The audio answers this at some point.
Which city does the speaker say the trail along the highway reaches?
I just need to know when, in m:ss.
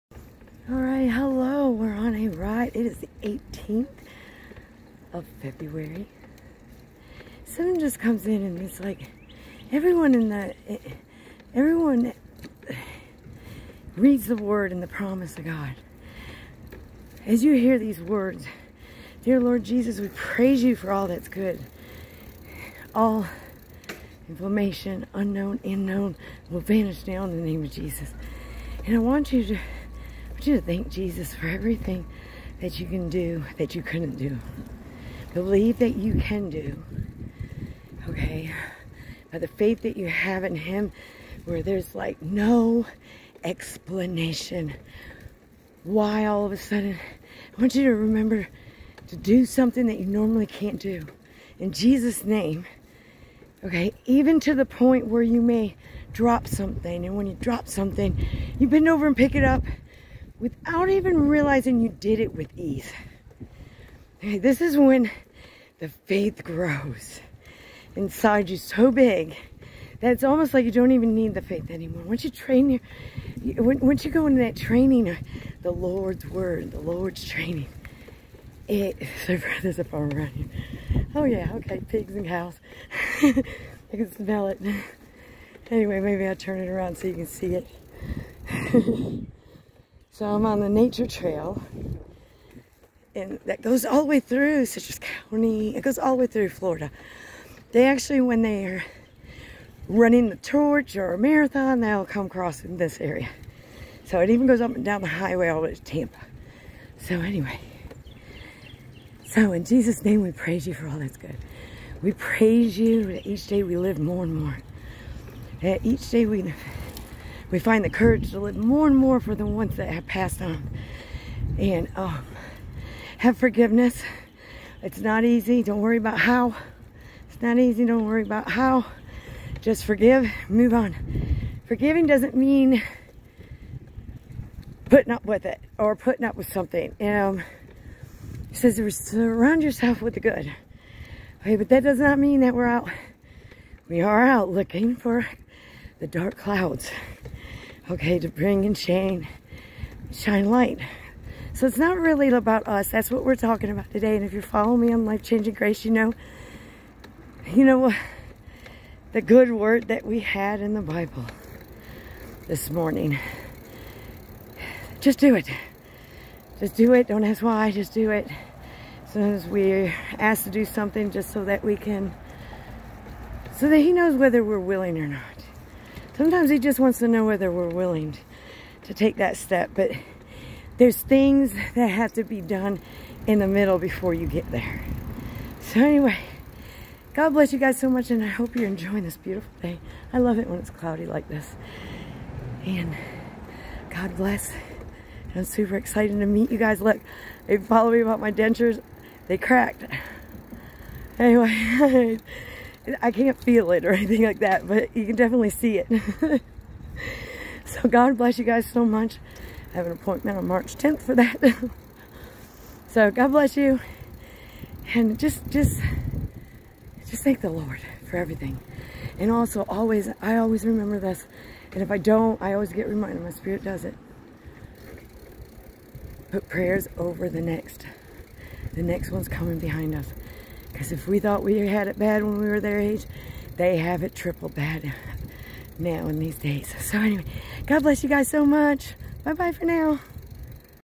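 1:45.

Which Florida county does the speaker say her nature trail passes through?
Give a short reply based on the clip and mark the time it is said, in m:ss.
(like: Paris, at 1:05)
Citrus County, at 1:34.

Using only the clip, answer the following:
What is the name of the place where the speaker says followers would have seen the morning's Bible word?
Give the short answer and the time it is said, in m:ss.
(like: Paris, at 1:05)
Life Changing Grace, at 2:35.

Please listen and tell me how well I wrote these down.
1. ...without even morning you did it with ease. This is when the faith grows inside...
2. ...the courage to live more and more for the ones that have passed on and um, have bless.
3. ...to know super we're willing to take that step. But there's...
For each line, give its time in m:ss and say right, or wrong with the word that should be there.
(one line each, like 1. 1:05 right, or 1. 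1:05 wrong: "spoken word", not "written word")
1. 1:00 wrong: "realizing", not "morning"
2. 1:57 wrong: "forgiveness", not "bless"
3. 2:56 wrong: "whether", not "super".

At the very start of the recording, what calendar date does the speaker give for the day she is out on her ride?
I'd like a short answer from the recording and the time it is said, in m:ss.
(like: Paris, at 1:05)
18th of February, at 0:03.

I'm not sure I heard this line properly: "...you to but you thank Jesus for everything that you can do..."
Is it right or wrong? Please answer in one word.
right.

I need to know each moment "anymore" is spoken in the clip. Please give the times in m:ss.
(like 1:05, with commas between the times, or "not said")
1:11.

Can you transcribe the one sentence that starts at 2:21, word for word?
Okay, but that does not mean that we're out.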